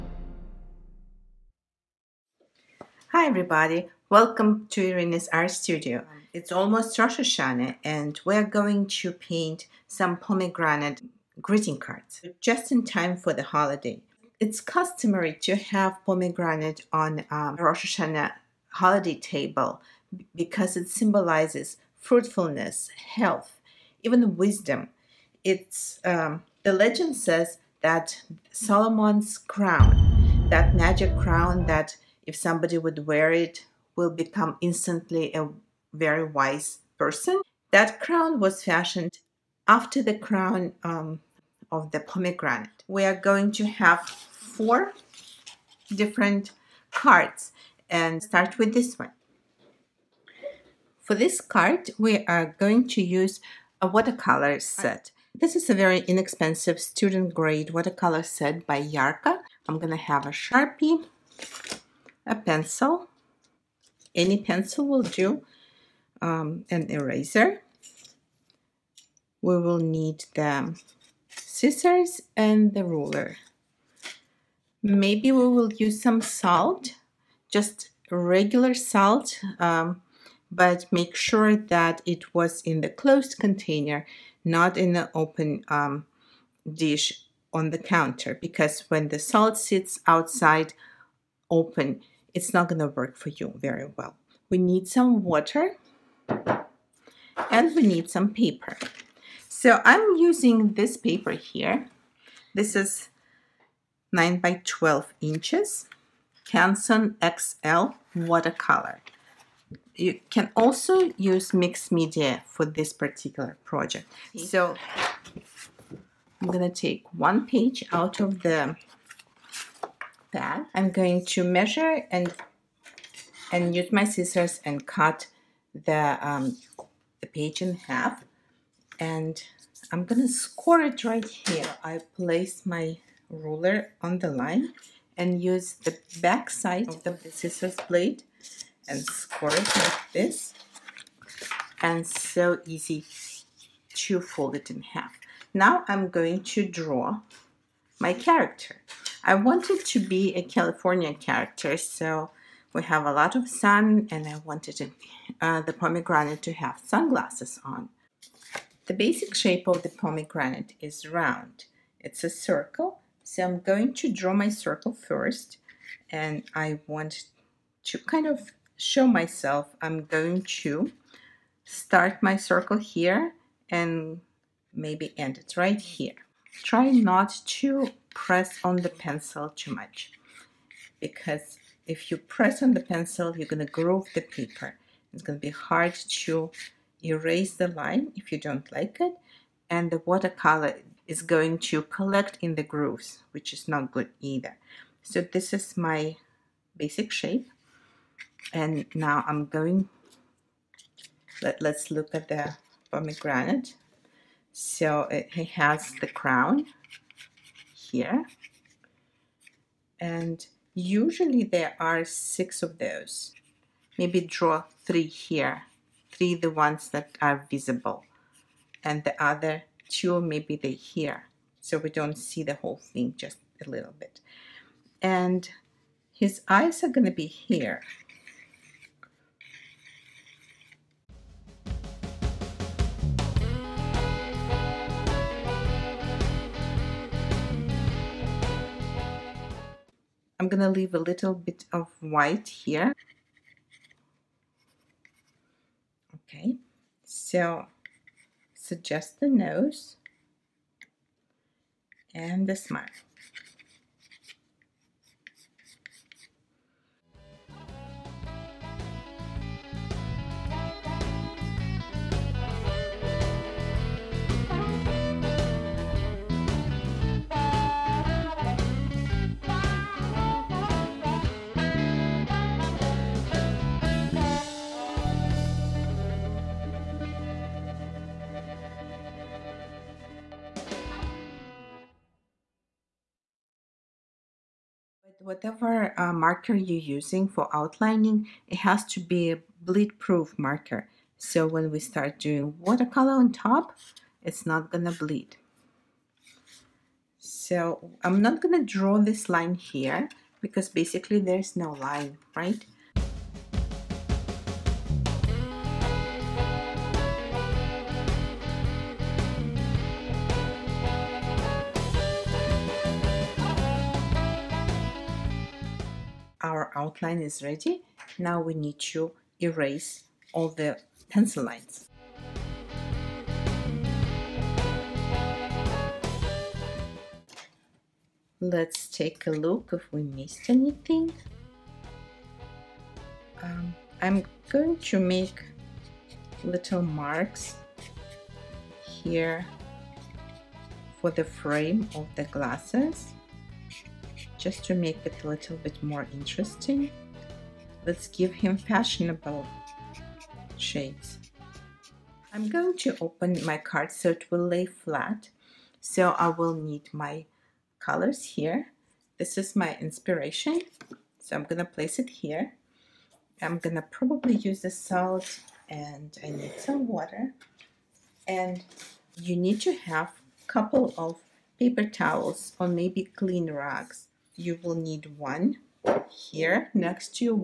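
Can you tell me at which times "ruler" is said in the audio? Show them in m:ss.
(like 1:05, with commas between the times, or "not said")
1:12, 2:13.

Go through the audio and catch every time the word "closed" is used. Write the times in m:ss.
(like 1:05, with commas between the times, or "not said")
1:22.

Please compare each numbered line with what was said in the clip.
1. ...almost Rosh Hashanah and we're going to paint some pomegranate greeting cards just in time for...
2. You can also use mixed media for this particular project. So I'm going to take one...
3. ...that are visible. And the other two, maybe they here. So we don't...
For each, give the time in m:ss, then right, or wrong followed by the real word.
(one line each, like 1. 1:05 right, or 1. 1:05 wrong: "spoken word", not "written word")
1. 0:06 right
2. 1:49 right
3. 3:36 right.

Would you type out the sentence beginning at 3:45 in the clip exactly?
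And his eyes are going to be here.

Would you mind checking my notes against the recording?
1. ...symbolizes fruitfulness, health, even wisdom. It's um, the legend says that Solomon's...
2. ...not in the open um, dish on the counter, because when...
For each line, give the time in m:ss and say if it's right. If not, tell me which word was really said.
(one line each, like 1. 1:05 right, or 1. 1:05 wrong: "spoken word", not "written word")
1. 0:20 right
2. 1:24 right.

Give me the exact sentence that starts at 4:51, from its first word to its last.
So when we start doing watercolor on top, it's not gonna bleed.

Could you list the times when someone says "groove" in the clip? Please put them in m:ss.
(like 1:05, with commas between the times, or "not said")
3:03, 3:12.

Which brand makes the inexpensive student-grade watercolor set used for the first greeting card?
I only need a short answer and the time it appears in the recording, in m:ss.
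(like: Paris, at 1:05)
Yarka, at 0:58.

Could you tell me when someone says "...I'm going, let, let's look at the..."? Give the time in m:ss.
3:19.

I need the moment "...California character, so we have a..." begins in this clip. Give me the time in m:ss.
2:30.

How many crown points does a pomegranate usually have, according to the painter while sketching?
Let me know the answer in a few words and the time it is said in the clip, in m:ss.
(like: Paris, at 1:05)
6, at 3:32.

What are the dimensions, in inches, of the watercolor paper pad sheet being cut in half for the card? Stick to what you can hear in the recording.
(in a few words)
9 by 12 inches.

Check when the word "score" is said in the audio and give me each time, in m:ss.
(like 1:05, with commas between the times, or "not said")
2:10, 2:19.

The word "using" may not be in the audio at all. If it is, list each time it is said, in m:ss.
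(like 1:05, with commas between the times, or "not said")
1:40, 4:46.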